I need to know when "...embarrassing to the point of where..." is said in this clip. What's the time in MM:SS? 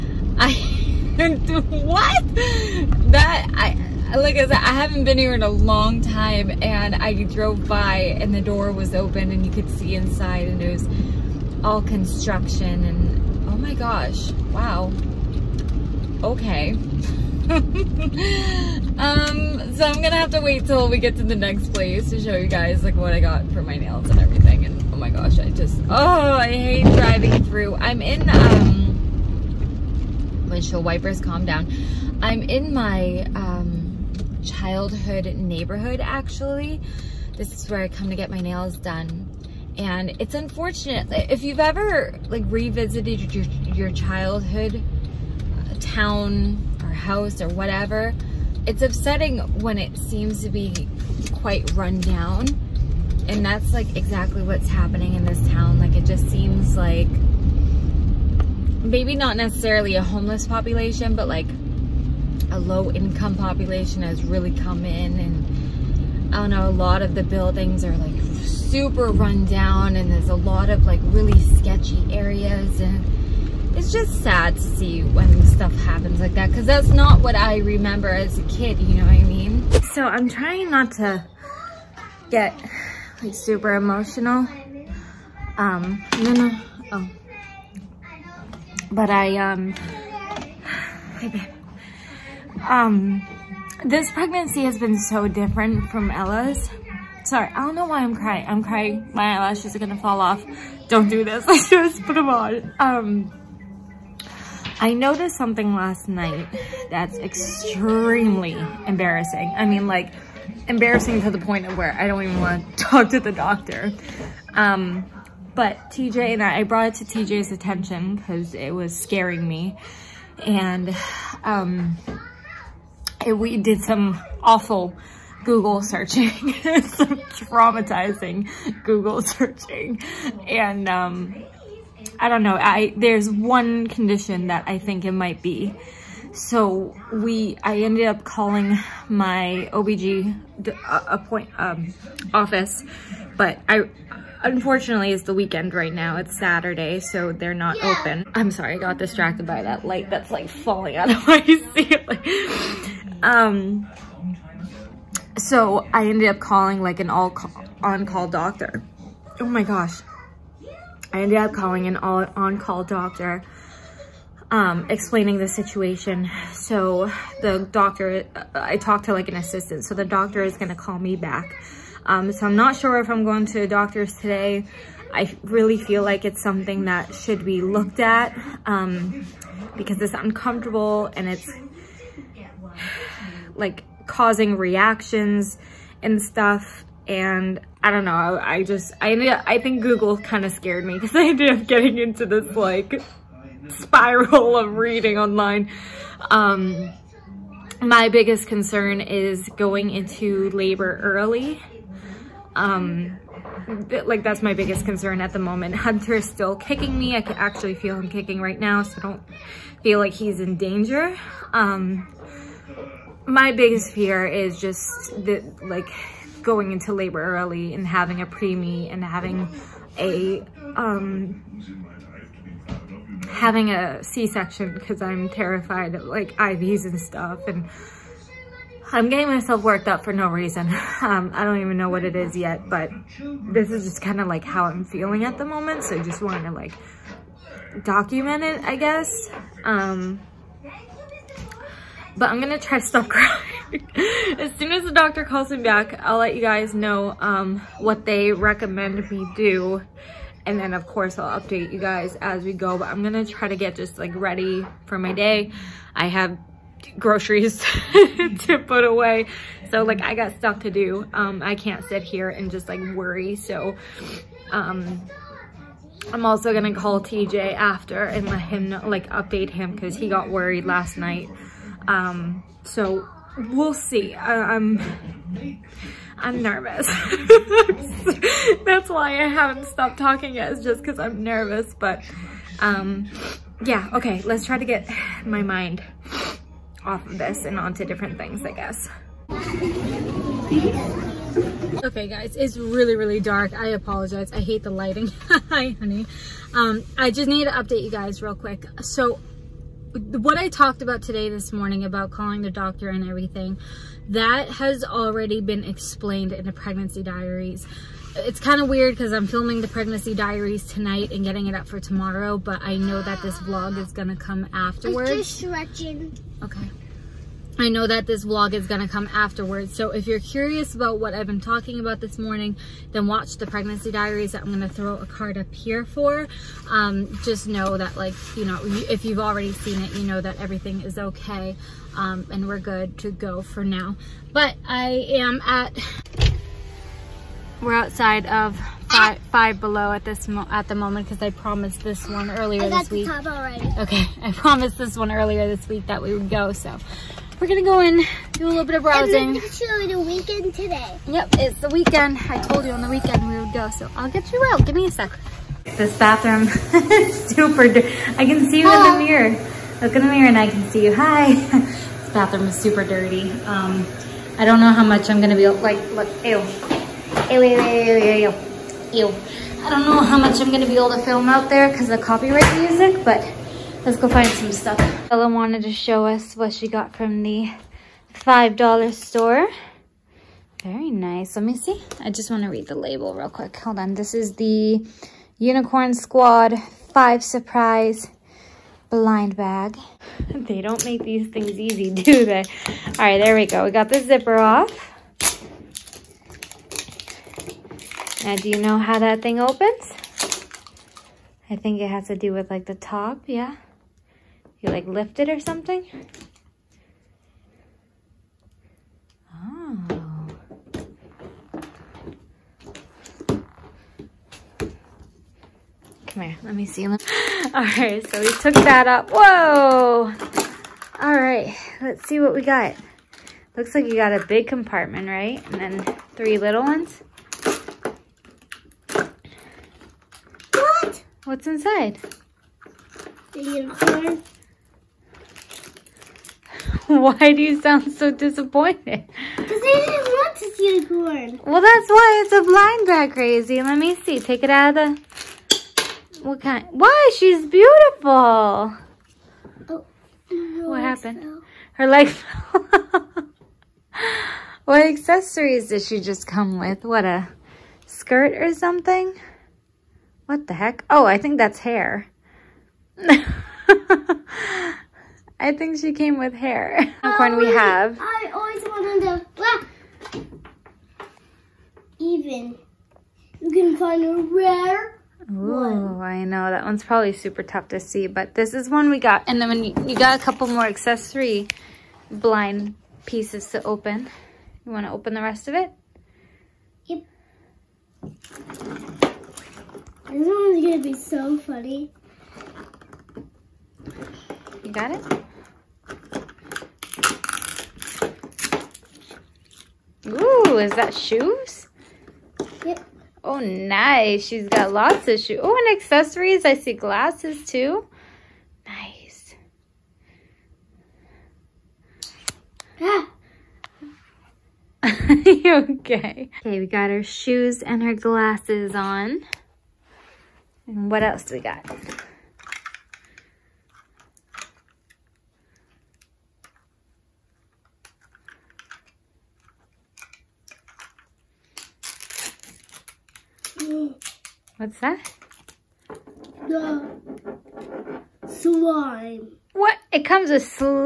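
01:50.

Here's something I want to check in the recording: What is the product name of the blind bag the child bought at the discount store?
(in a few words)
Unicorn Squad 5 Surprise.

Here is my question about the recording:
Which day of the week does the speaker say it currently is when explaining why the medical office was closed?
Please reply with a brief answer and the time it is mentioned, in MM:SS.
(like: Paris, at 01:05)
Saturday, at 02:26.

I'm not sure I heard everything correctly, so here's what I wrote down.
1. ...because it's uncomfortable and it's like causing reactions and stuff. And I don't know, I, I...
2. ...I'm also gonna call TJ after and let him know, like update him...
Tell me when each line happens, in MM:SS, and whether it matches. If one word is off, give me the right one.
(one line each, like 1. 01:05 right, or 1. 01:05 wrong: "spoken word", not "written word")
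1. 02:59 right
2. 04:26 right.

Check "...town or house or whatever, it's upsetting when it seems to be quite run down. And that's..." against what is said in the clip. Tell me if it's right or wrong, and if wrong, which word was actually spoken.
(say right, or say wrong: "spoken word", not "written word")
right.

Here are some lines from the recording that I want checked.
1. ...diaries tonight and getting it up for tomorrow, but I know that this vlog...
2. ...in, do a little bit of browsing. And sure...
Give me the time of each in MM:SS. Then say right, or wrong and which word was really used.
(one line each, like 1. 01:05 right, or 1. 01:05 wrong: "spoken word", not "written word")
1. 05:10 right
2. 05:47 right.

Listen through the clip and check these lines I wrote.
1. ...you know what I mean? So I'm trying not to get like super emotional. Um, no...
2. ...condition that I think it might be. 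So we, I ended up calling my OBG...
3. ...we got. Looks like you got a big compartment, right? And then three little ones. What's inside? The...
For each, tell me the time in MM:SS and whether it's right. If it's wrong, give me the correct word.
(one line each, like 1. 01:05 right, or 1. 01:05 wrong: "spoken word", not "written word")
1. 01:18 right
2. 02:13 right
3. 07:02 right.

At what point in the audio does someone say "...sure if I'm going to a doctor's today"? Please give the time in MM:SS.
02:52.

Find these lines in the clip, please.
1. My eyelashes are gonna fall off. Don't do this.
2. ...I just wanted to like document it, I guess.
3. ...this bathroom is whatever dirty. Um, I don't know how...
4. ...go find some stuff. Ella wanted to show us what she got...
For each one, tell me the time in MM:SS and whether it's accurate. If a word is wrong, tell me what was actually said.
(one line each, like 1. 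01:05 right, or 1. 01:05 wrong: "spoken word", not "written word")
1. 01:39 right
2. 03:55 right
3. 06:01 wrong: "super", not "whatever"
4. 06:13 right.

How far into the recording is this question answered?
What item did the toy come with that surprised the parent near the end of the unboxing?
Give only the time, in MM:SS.
08:58.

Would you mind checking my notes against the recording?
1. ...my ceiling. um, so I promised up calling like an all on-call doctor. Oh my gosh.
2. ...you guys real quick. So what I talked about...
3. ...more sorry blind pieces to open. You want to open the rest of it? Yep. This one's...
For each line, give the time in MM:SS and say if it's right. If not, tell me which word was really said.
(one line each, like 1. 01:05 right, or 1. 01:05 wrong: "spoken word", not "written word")
1. 02:31 wrong: "ended", not "promised"
2. 04:57 right
3. 08:00 wrong: "accessory", not "sorry".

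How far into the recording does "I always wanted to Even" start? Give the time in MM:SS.
07:48.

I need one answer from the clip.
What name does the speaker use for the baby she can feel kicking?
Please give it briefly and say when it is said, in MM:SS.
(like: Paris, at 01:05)
Hunter, at 03:25.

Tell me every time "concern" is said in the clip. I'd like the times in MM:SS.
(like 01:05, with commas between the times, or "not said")
03:18, 03:24.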